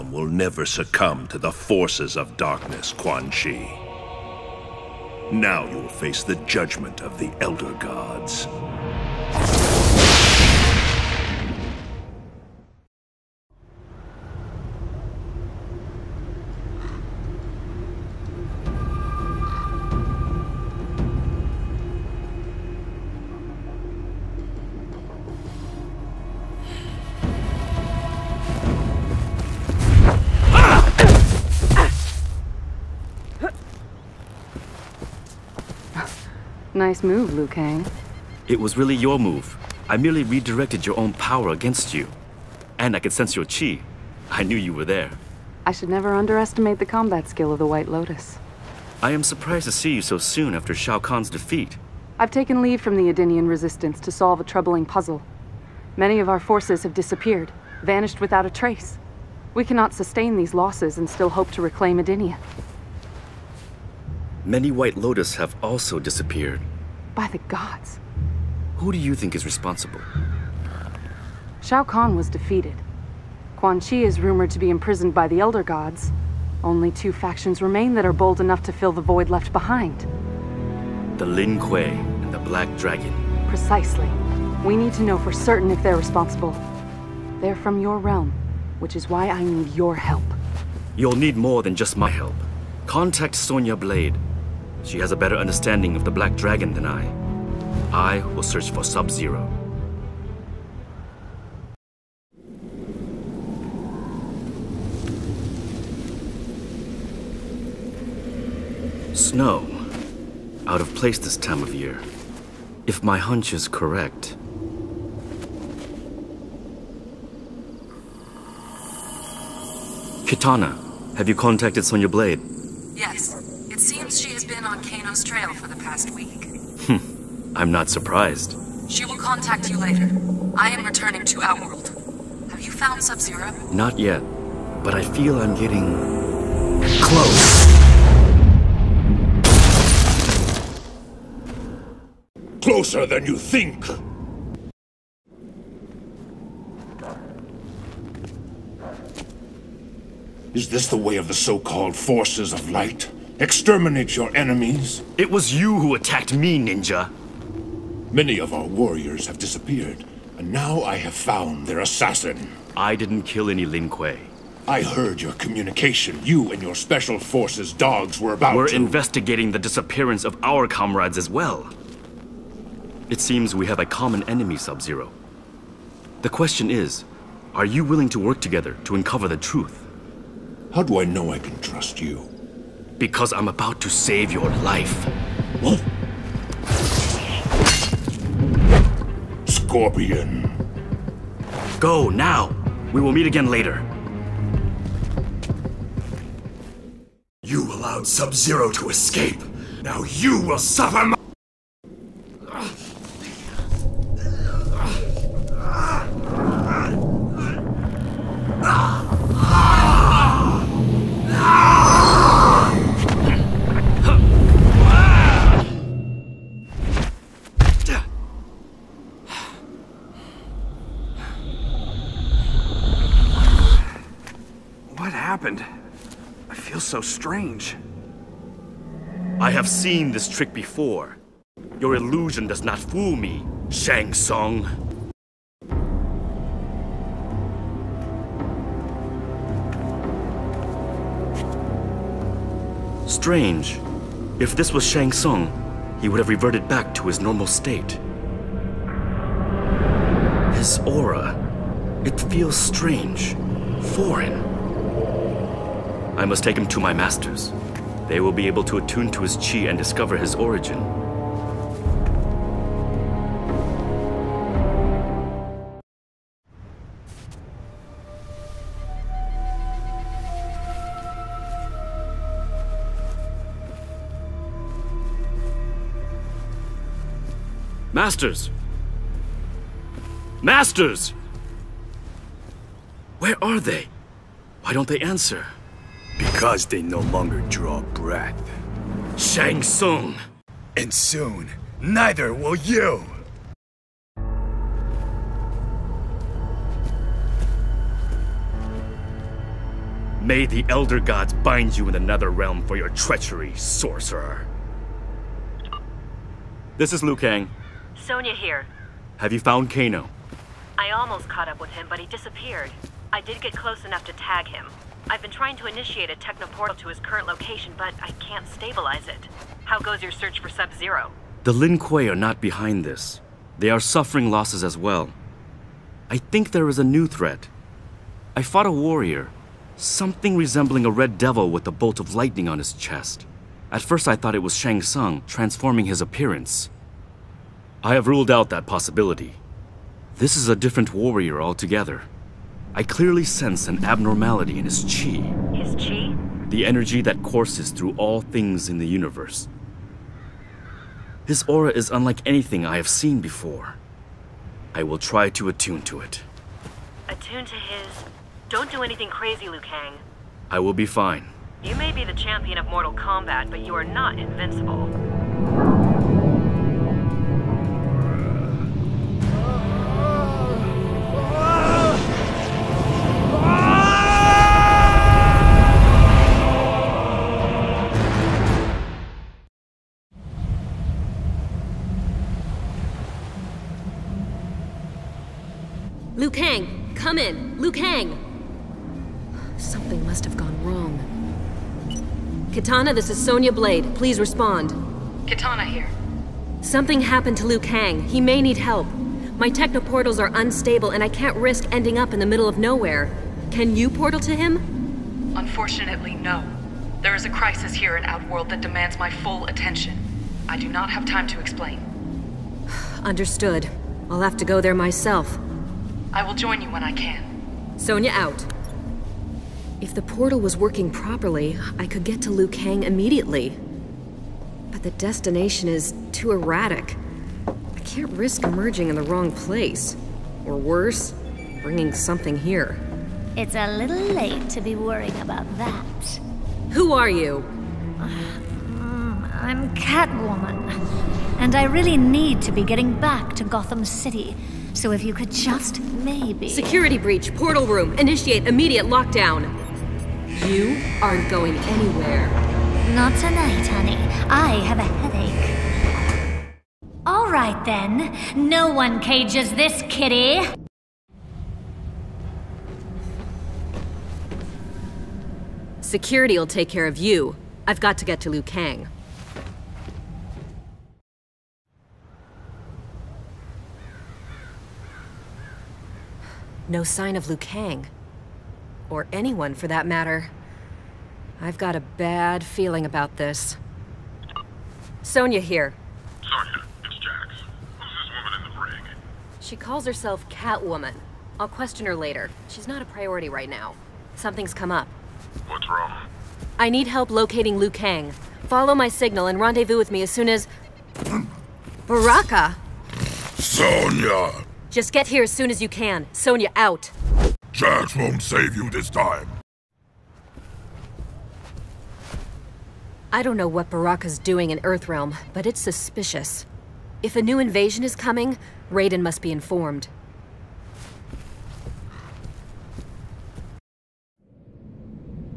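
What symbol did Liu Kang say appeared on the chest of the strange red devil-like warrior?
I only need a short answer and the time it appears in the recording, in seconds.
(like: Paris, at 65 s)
A bolt of lightning, at 331 s.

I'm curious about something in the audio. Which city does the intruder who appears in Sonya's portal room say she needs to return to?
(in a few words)
Gotham City.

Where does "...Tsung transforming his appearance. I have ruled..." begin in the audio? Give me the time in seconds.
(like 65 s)
334 s.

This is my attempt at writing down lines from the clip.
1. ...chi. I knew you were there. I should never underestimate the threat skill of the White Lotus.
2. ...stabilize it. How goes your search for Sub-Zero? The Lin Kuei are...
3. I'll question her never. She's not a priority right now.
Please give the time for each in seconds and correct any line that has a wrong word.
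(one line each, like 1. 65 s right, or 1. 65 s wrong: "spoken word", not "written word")
1. 43 s wrong: "combat", not "threat"
2. 318 s right
3. 491 s wrong: "later", not "never".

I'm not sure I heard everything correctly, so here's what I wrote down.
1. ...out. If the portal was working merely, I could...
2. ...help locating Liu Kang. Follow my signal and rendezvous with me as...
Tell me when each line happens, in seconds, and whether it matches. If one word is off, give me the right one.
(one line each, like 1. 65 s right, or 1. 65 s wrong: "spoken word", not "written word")
1. 418 s wrong: "properly", not "merely"
2. 496 s right.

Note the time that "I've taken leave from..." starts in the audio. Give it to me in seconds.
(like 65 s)
52 s.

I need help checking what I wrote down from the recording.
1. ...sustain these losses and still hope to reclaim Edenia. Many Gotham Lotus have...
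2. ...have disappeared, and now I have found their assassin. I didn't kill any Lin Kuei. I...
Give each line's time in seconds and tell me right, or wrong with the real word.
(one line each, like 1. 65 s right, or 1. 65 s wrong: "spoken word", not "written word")
1. 59 s wrong: "White", not "Gotham"
2. 159 s right.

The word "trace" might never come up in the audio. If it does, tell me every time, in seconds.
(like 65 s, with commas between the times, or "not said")
58 s.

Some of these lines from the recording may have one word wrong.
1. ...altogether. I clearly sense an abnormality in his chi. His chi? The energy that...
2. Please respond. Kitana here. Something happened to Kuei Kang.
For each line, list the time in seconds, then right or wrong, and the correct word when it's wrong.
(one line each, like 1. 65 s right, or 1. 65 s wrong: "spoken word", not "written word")
1. 341 s right
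2. 393 s wrong: "Liu", not "Kuei".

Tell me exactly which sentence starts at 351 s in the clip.
His aura is unlike anything I have seen before.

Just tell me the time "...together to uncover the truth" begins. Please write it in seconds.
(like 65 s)
178 s.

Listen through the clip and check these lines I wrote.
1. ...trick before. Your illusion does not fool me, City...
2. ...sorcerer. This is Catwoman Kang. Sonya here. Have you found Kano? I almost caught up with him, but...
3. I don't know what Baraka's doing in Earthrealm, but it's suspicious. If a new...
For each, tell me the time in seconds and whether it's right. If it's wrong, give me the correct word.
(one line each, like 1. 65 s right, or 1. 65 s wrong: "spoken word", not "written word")
1. 230 s wrong: "Shang", not "City"
2. 303 s wrong: "Liu", not "Catwoman"
3. 513 s right.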